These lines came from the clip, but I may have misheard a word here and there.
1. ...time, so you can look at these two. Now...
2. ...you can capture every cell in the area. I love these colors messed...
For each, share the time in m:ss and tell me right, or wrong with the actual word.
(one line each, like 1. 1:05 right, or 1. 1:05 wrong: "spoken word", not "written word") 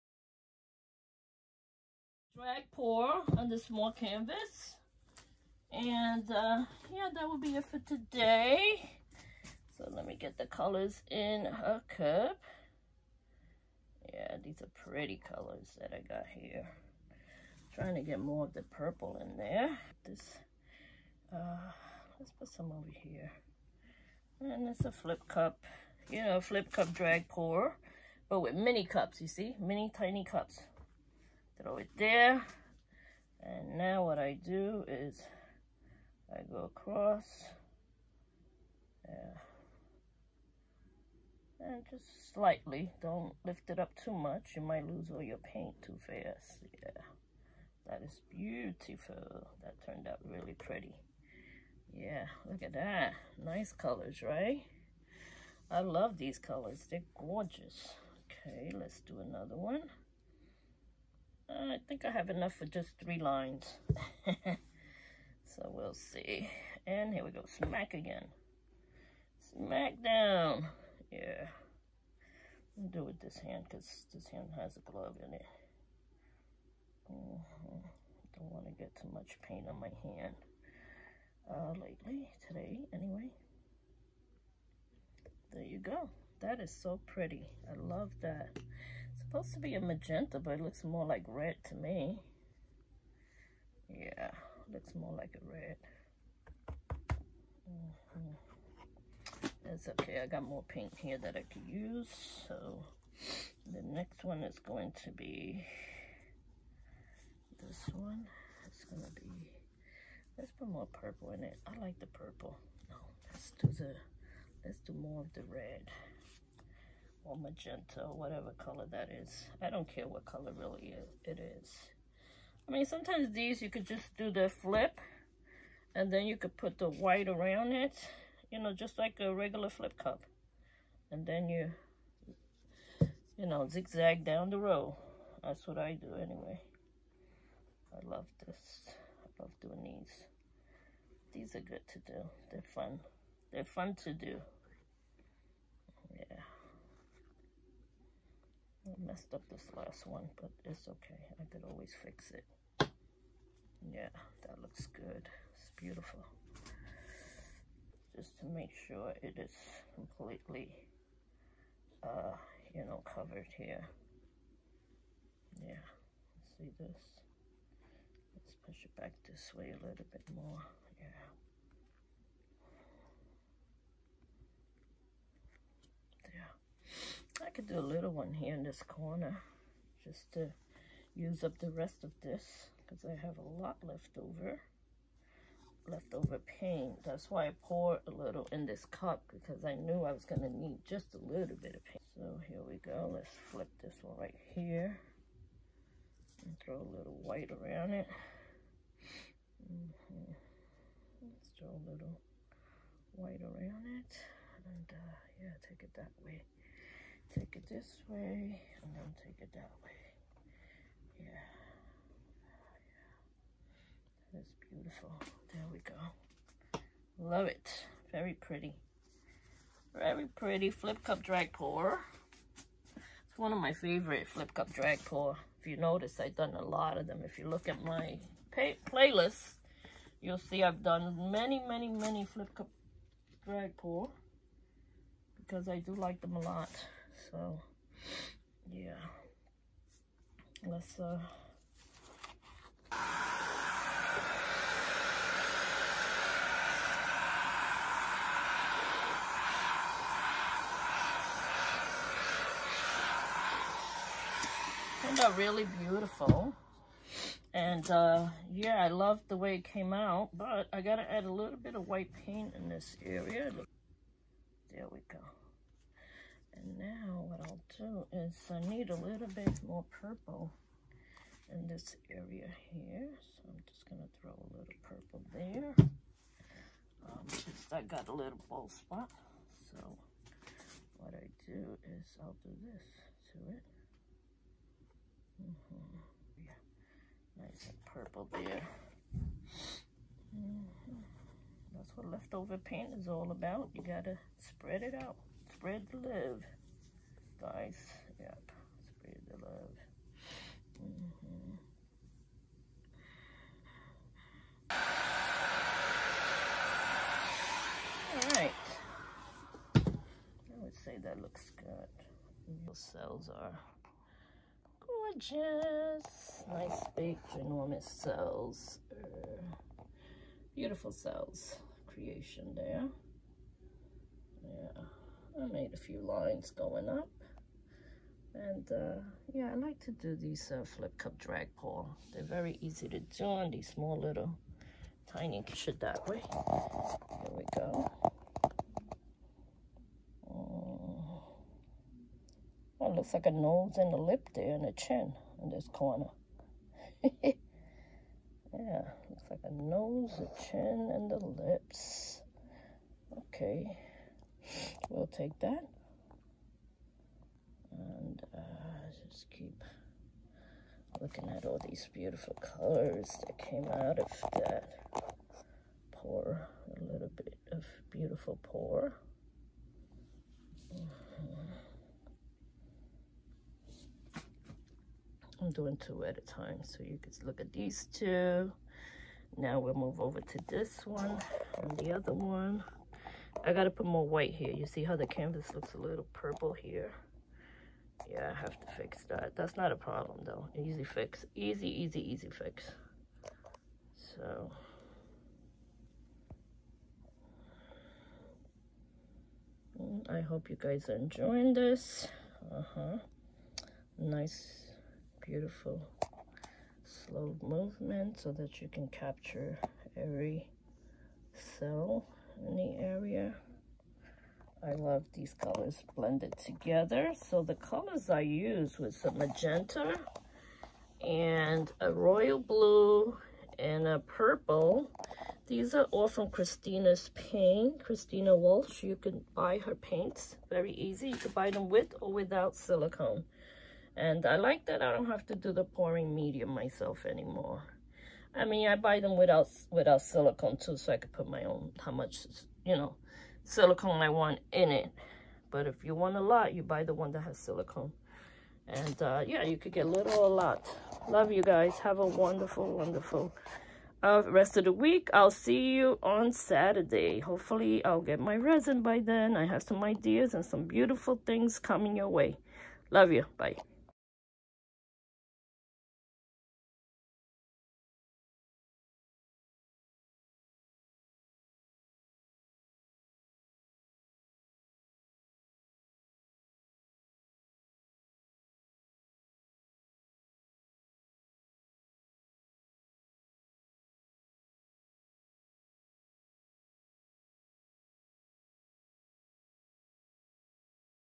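1. 6:16 right
2. 6:48 wrong: "blended", not "messed".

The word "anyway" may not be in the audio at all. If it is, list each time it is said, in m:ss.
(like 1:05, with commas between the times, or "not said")
1:22, 2:16.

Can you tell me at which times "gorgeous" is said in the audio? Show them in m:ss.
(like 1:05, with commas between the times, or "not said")
0:57, 5:14.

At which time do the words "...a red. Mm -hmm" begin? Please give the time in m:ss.
1:35.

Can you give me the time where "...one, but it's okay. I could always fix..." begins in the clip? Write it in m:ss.
2:30.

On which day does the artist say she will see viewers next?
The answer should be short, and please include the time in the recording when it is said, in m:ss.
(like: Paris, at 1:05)
Saturday, at 7:36.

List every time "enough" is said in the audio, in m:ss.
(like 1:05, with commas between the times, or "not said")
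1:02.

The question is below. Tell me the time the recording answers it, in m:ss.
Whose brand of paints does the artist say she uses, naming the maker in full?
7:07.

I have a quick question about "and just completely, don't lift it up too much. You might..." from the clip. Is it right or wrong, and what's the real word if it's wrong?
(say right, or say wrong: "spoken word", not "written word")
wrong: "slightly", not "completely".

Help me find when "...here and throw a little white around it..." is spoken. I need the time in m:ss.
3:14.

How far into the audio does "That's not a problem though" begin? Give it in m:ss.
6:29.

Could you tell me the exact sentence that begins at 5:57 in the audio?
And uh, just keep looking at all these beautiful colors that came out of that pour.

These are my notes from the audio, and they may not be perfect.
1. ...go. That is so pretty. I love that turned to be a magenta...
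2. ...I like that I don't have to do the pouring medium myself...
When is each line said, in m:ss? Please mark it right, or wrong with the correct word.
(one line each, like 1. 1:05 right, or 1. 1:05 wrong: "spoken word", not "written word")
1. 1:25 wrong: "supposed", not "turned"
2. 7:14 right.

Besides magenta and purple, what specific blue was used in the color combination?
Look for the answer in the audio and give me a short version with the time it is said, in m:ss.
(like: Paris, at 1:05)
royal blue, at 7:01.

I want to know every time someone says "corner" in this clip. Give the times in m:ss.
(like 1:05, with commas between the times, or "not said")
2:58, 5:45.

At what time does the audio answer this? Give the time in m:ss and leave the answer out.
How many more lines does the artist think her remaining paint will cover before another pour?
1:03.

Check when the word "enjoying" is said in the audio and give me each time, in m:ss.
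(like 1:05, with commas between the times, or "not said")
6:40.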